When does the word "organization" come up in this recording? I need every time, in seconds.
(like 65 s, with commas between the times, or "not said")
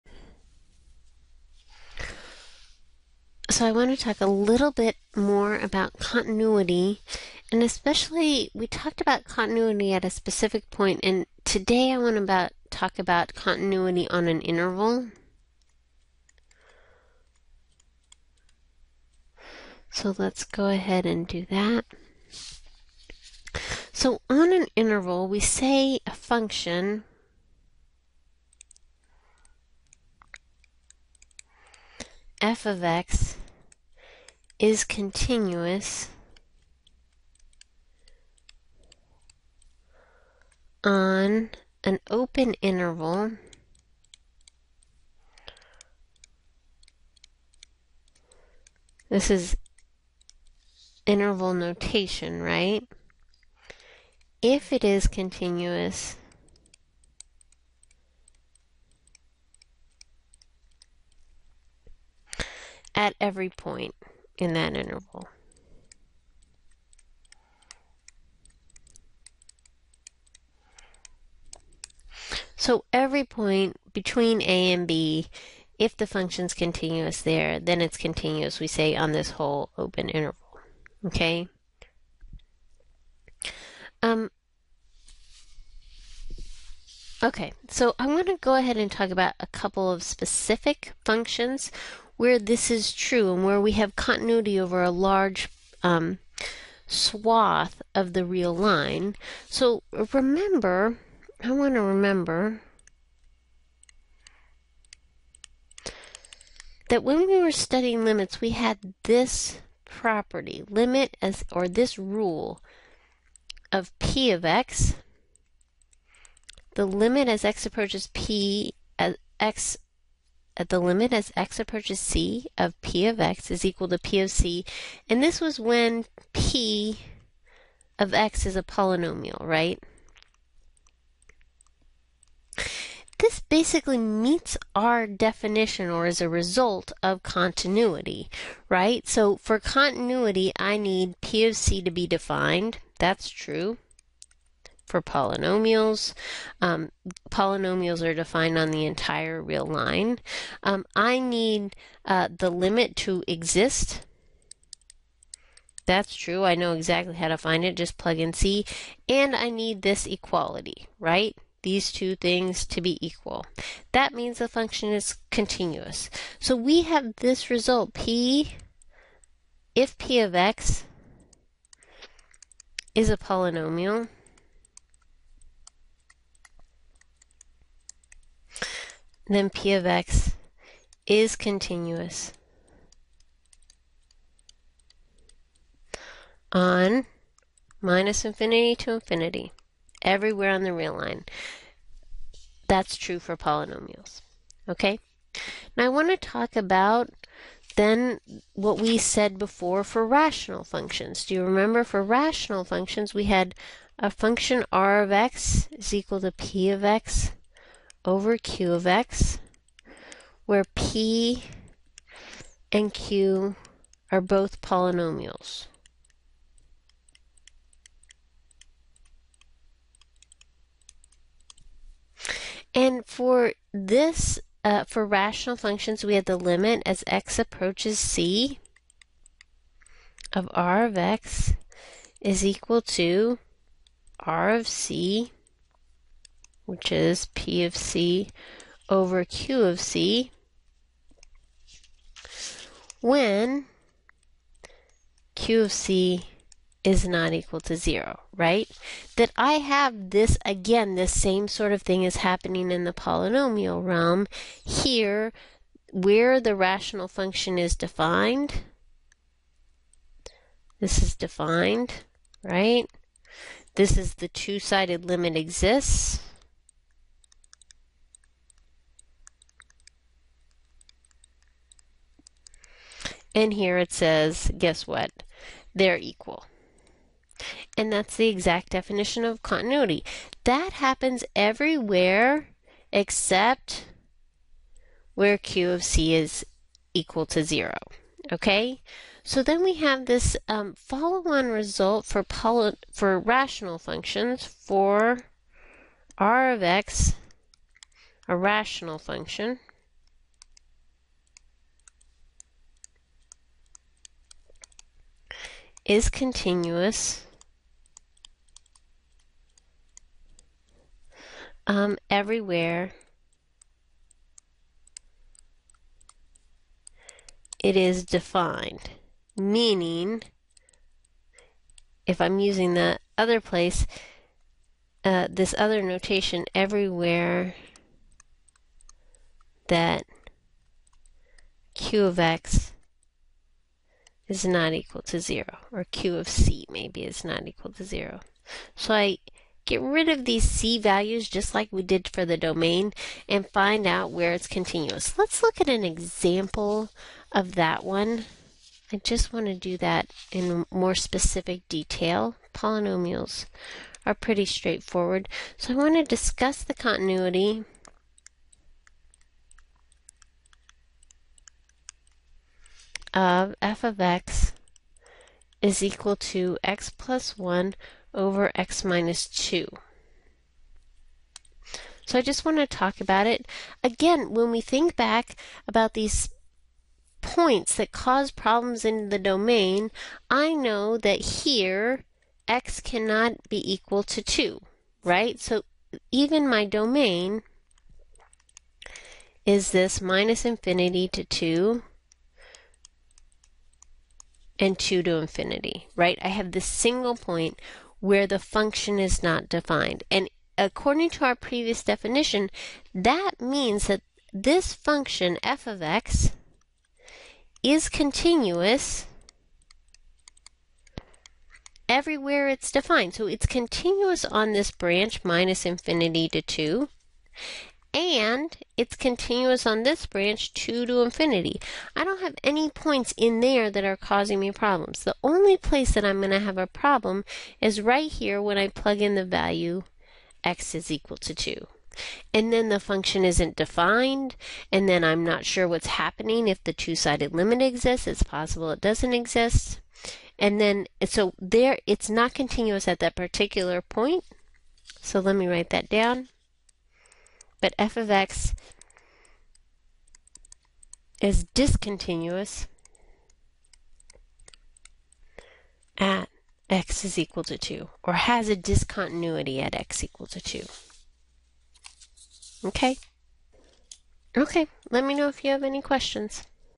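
not said.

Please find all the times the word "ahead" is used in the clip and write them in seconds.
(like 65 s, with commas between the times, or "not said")
20 s, 88 s.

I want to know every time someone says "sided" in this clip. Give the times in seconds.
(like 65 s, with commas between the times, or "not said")
264 s, 436 s.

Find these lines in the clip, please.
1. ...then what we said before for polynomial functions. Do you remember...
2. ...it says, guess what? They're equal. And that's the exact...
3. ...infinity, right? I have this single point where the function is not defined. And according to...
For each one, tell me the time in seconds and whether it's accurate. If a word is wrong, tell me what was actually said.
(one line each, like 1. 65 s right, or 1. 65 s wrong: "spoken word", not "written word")
1. 197 s wrong: "rational", not "polynomial"
2. 273 s right
3. 395 s right.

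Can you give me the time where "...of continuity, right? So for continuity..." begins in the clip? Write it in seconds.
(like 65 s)
137 s.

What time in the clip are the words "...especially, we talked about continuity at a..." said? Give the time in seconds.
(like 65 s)
7 s.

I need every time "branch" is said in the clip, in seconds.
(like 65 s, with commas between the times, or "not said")
414 s, 420 s.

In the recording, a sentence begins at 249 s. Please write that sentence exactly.
That I have this, again, this same sort of thing is happening in the polynomial realm.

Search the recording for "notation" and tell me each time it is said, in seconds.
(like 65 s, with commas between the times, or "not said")
51 s, 325 s.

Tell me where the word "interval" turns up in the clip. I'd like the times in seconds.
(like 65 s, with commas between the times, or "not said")
14 s, 24 s, 42 s, 51 s, 64 s, 80 s.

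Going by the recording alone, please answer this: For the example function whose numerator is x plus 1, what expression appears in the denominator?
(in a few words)
x - 2.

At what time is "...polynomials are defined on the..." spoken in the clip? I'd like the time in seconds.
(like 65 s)
147 s.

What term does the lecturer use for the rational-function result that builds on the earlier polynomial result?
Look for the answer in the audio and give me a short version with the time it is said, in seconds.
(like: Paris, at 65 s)
follow-on result, at 290 s.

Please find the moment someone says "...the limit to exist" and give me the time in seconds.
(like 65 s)
152 s.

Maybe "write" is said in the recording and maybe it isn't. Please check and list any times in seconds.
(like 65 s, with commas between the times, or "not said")
445 s.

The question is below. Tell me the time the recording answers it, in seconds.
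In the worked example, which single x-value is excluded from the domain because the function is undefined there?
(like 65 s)
382 s.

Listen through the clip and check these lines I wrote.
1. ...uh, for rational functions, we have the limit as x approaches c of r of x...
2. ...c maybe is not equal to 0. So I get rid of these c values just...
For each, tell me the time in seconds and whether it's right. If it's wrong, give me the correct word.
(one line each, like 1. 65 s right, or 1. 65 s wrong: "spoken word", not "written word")
1. 224 s right
2. 336 s right.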